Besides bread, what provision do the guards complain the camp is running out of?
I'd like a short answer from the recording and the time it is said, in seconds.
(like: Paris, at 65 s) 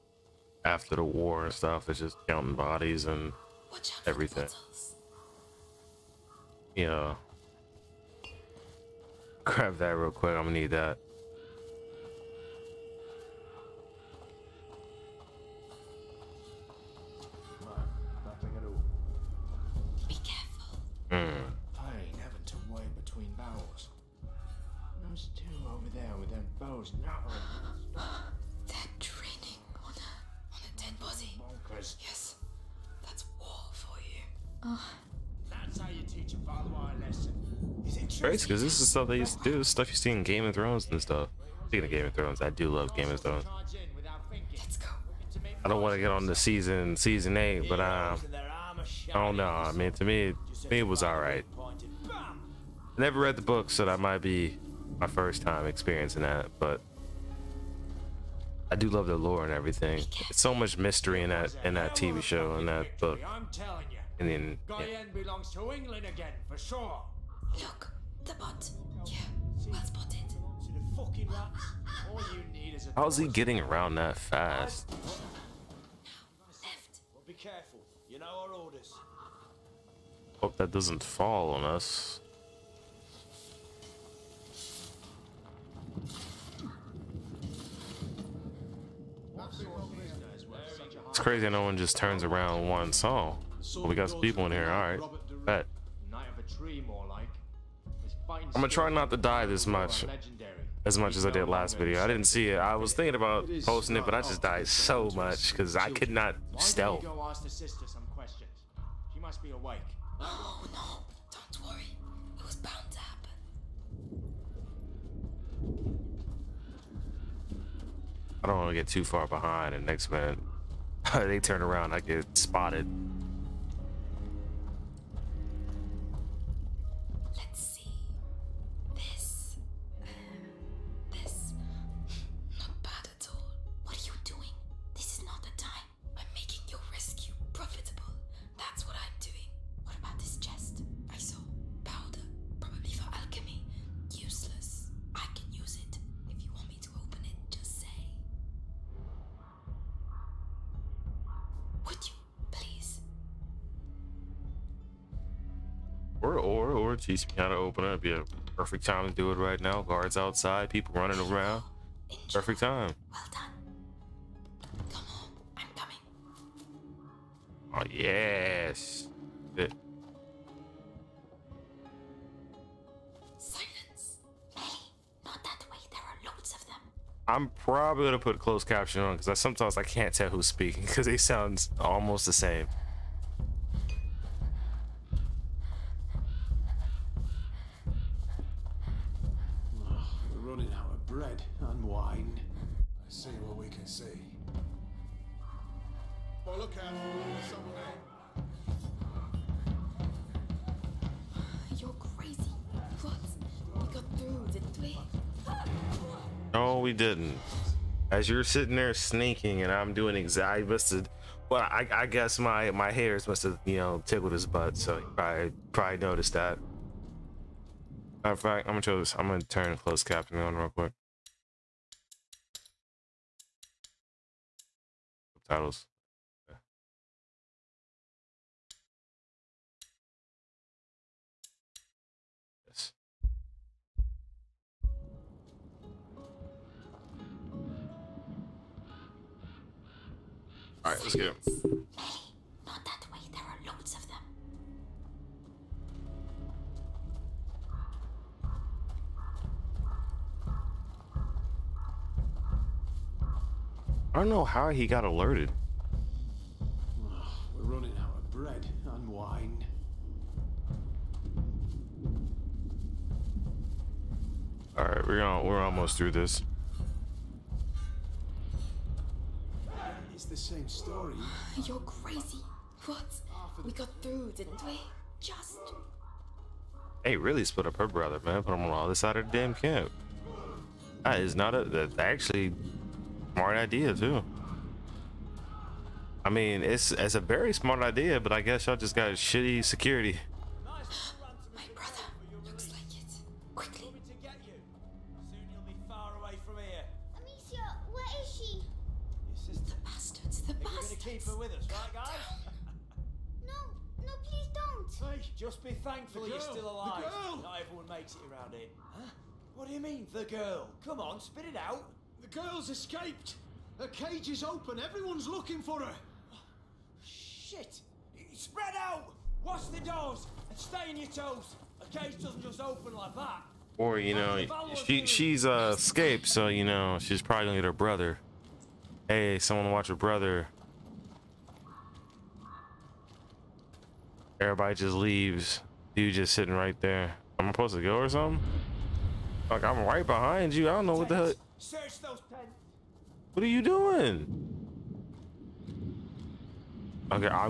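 Wine, at 259 s.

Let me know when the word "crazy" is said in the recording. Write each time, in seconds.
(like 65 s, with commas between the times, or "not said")
91 s, 271 s.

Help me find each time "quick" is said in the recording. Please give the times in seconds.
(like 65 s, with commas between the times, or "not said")
10 s, 220 s.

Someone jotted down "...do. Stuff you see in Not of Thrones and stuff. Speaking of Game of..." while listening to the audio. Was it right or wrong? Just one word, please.
wrong.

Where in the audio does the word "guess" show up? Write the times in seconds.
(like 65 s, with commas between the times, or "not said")
212 s, 288 s.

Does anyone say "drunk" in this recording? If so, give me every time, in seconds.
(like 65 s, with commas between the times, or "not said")
not said.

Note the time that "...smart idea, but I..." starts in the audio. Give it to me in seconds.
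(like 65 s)
287 s.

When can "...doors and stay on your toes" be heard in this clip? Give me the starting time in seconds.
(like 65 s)
319 s.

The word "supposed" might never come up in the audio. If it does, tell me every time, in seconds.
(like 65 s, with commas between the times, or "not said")
337 s.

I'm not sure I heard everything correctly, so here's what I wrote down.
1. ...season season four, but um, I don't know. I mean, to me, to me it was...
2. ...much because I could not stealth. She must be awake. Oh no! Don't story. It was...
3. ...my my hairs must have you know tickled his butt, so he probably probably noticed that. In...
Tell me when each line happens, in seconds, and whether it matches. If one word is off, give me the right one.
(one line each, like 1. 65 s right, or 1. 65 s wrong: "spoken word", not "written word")
1. 46 s wrong: "eight", not "four"
2. 105 s wrong: "worry", not "story"
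3. 212 s right.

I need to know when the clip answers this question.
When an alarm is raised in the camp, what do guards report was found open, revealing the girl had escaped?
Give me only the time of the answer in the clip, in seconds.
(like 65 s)
313 s.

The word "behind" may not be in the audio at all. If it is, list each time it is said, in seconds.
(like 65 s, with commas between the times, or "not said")
119 s, 340 s.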